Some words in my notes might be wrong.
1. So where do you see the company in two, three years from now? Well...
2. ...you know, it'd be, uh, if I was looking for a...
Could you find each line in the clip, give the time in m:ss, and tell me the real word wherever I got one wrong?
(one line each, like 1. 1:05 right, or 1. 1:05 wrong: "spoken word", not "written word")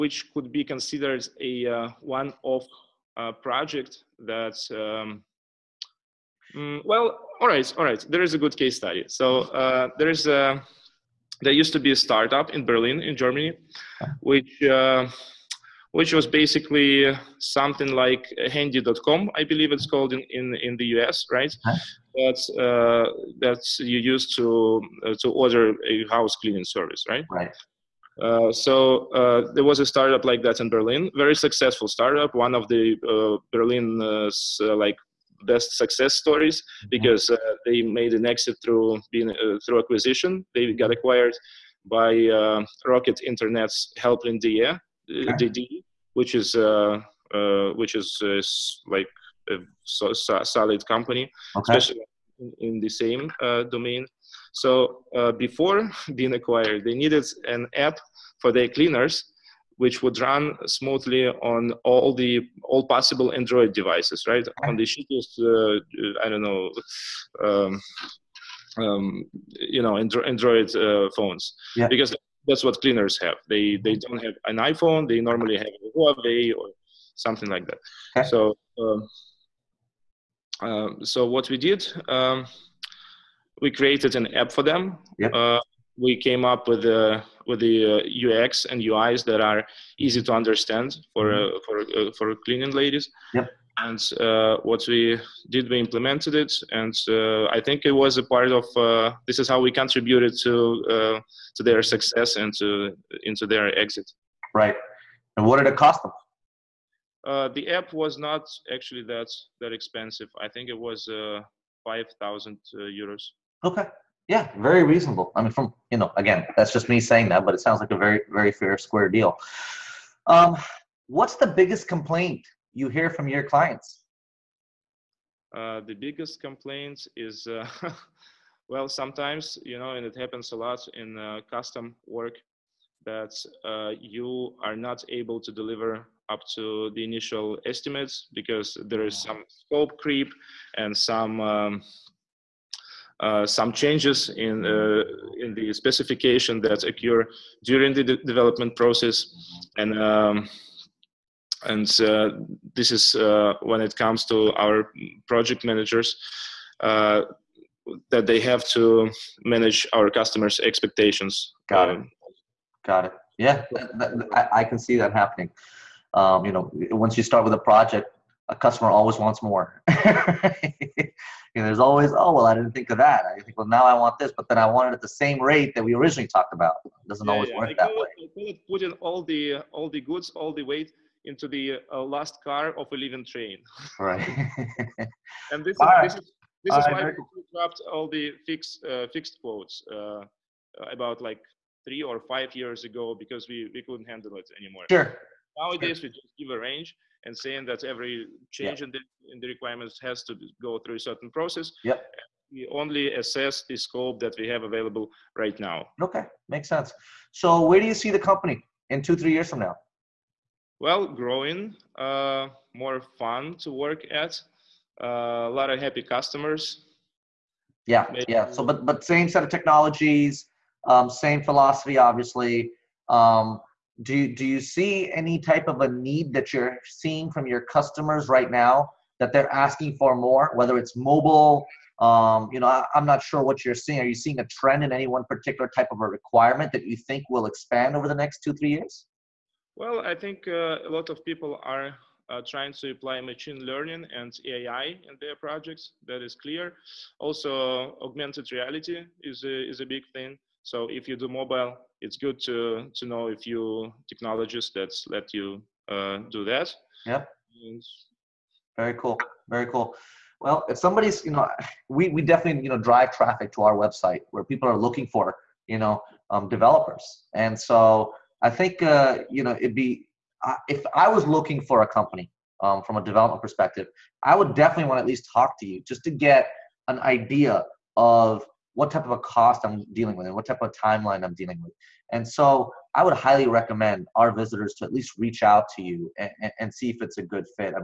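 1. 3:27 right
2. 4:29 right.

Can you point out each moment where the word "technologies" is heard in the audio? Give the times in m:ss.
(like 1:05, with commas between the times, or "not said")
3:39, 4:14.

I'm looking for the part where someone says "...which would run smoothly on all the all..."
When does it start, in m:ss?
0:59.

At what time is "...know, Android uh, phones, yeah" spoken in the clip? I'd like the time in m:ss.
1:09.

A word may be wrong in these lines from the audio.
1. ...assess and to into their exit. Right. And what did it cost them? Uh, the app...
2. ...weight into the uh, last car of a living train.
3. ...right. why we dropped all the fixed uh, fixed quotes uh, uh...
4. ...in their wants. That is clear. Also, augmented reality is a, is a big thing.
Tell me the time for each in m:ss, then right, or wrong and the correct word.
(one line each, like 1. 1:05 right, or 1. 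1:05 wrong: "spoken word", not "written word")
1. 1:41 wrong: "success", not "assess"
2. 3:00 right
3. 3:06 right
4. 4:05 wrong: "projects", not "wants".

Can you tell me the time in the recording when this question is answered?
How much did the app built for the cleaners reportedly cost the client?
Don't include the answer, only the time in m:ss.
1:51.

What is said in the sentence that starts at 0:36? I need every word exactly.
because uh, they made an exit through being uh, through acquisition.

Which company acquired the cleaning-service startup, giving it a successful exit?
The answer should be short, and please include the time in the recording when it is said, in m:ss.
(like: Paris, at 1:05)
Helpling, at 0:43.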